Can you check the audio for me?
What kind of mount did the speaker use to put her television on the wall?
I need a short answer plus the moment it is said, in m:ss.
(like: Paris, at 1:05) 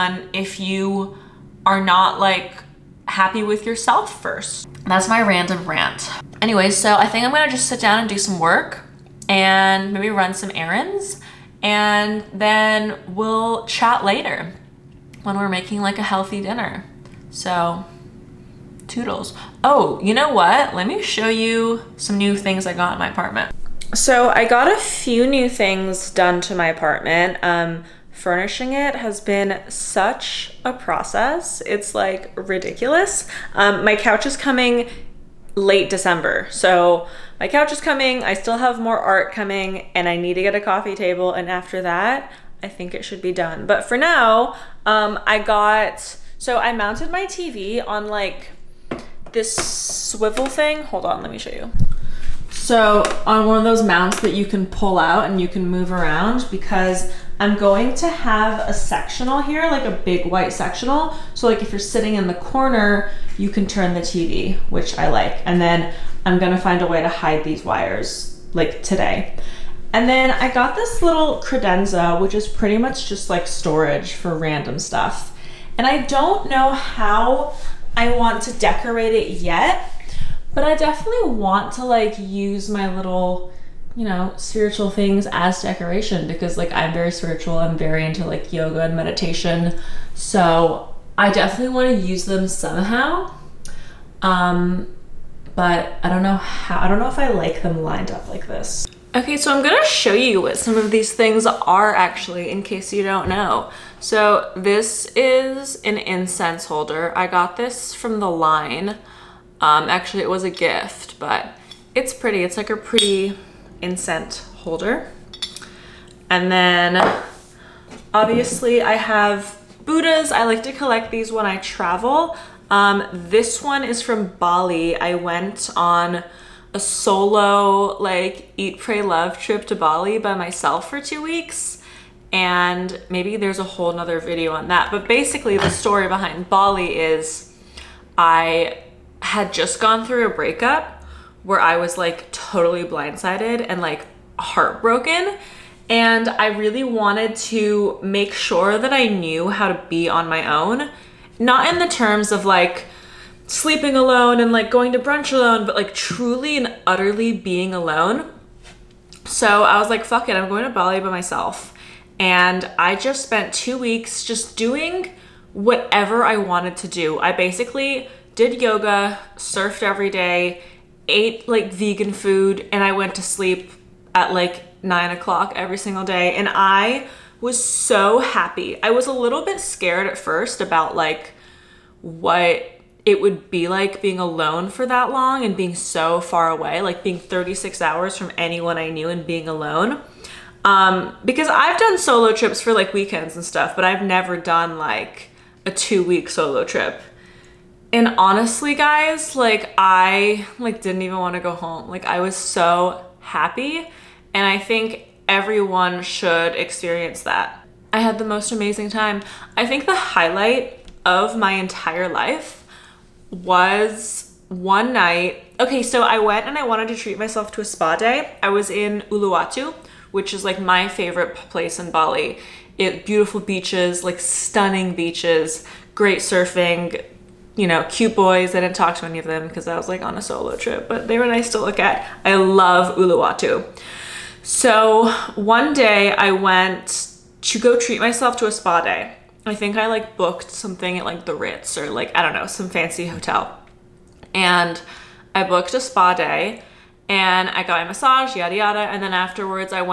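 Swivel, at 0:49.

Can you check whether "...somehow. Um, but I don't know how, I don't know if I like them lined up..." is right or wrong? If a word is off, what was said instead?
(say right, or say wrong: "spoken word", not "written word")
right.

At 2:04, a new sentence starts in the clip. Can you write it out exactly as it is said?
I went on a solo like eat, pray, love trip to Bali by myself for two weeks.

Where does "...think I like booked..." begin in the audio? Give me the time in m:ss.
3:59.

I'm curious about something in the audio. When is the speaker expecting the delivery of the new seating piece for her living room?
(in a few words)
Late December.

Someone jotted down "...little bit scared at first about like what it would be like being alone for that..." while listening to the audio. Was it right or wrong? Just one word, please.
right.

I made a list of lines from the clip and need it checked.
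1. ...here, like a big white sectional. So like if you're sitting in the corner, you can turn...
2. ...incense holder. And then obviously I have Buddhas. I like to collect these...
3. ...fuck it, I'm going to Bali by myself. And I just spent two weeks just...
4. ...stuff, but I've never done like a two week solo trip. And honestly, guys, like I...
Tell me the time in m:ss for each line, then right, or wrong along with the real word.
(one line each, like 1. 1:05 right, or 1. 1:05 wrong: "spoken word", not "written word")
1. 0:59 right
2. 1:53 right
3. 2:40 right
4. 3:13 right.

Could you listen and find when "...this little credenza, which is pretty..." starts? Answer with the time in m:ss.
1:10.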